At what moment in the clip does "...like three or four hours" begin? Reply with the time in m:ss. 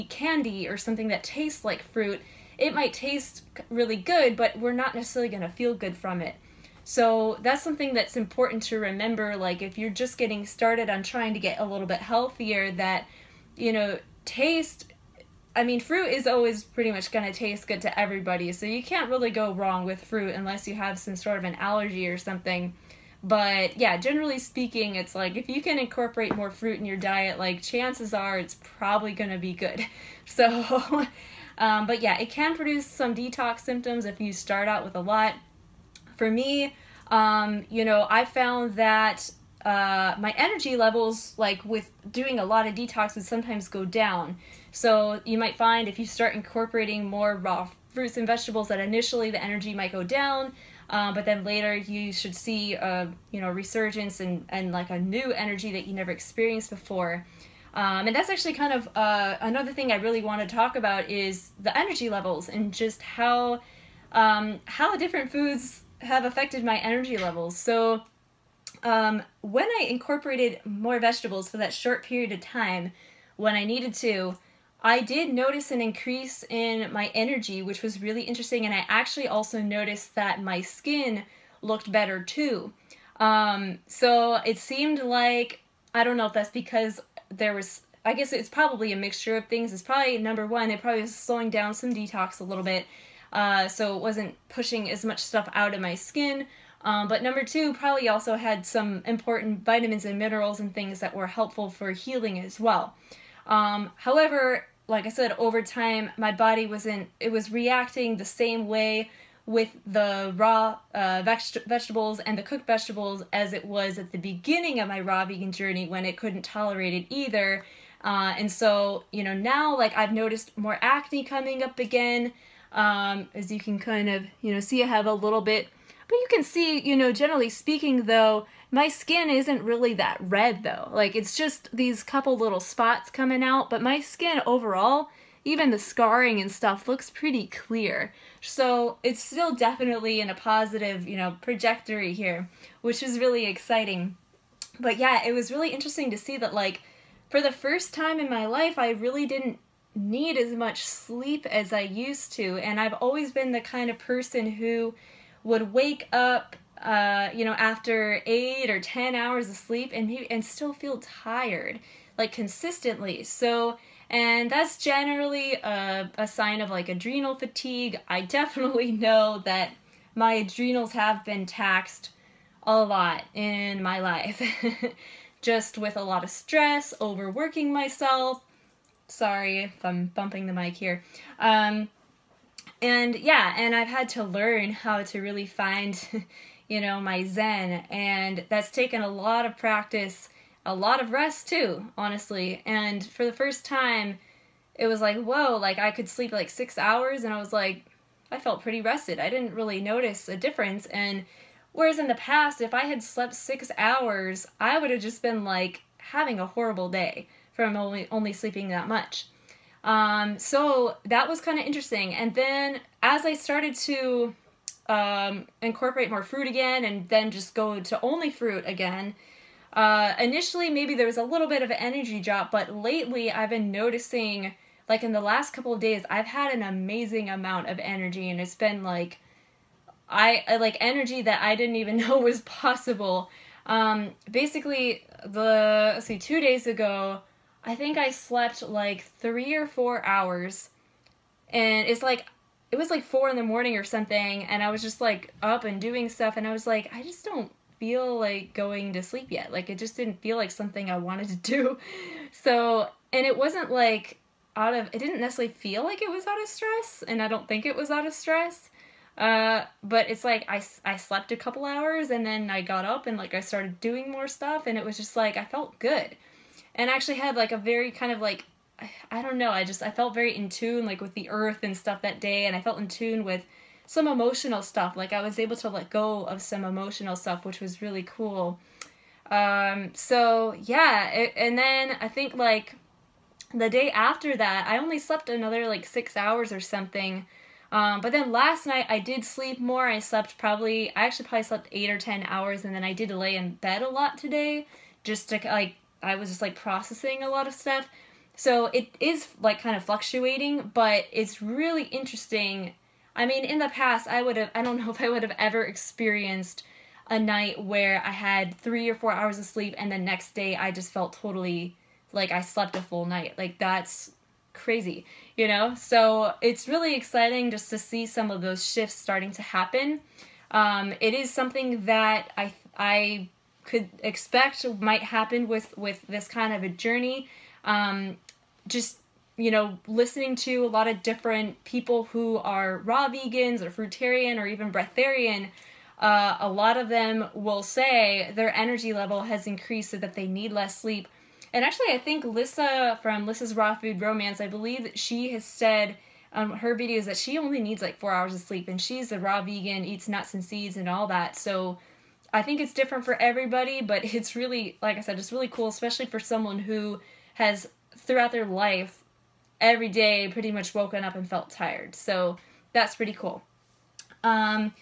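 3:58.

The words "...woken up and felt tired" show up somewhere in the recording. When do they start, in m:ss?
6:00.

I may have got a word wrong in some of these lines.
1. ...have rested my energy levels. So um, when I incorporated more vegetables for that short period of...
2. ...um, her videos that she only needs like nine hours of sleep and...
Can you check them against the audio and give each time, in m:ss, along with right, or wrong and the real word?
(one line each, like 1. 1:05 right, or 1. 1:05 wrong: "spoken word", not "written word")
1. 1:05 wrong: "affected", not "rested"
2. 5:46 wrong: "four", not "nine".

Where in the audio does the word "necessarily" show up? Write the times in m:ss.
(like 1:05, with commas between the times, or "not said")
0:04, 4:15.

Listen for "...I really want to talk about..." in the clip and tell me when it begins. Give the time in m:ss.
0:59.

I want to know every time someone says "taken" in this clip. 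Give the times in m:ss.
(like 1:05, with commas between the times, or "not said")
3:08.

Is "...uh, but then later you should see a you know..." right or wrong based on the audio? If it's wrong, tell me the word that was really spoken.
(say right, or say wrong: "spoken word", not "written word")
right.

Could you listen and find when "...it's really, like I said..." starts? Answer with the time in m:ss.
5:54.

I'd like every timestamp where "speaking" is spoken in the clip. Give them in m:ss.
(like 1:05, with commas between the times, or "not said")
0:24, 2:07.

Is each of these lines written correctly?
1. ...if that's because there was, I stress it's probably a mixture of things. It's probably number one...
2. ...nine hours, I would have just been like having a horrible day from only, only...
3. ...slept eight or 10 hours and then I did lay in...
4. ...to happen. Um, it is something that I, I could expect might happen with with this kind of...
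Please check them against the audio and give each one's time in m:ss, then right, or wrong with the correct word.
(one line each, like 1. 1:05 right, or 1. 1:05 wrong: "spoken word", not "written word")
1. 1:26 wrong: "guess", not "stress"
2. 3:23 wrong: "six", not "nine"
3. 4:51 right
4. 5:19 right.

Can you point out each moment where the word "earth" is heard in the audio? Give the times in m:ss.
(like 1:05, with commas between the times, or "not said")
4:31.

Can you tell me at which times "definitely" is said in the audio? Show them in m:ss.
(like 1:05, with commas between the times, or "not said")
2:19, 2:48.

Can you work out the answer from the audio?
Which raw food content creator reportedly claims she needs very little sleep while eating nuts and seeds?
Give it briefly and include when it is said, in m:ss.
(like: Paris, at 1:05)
Lissa's Raw Food Romance, at 5:43.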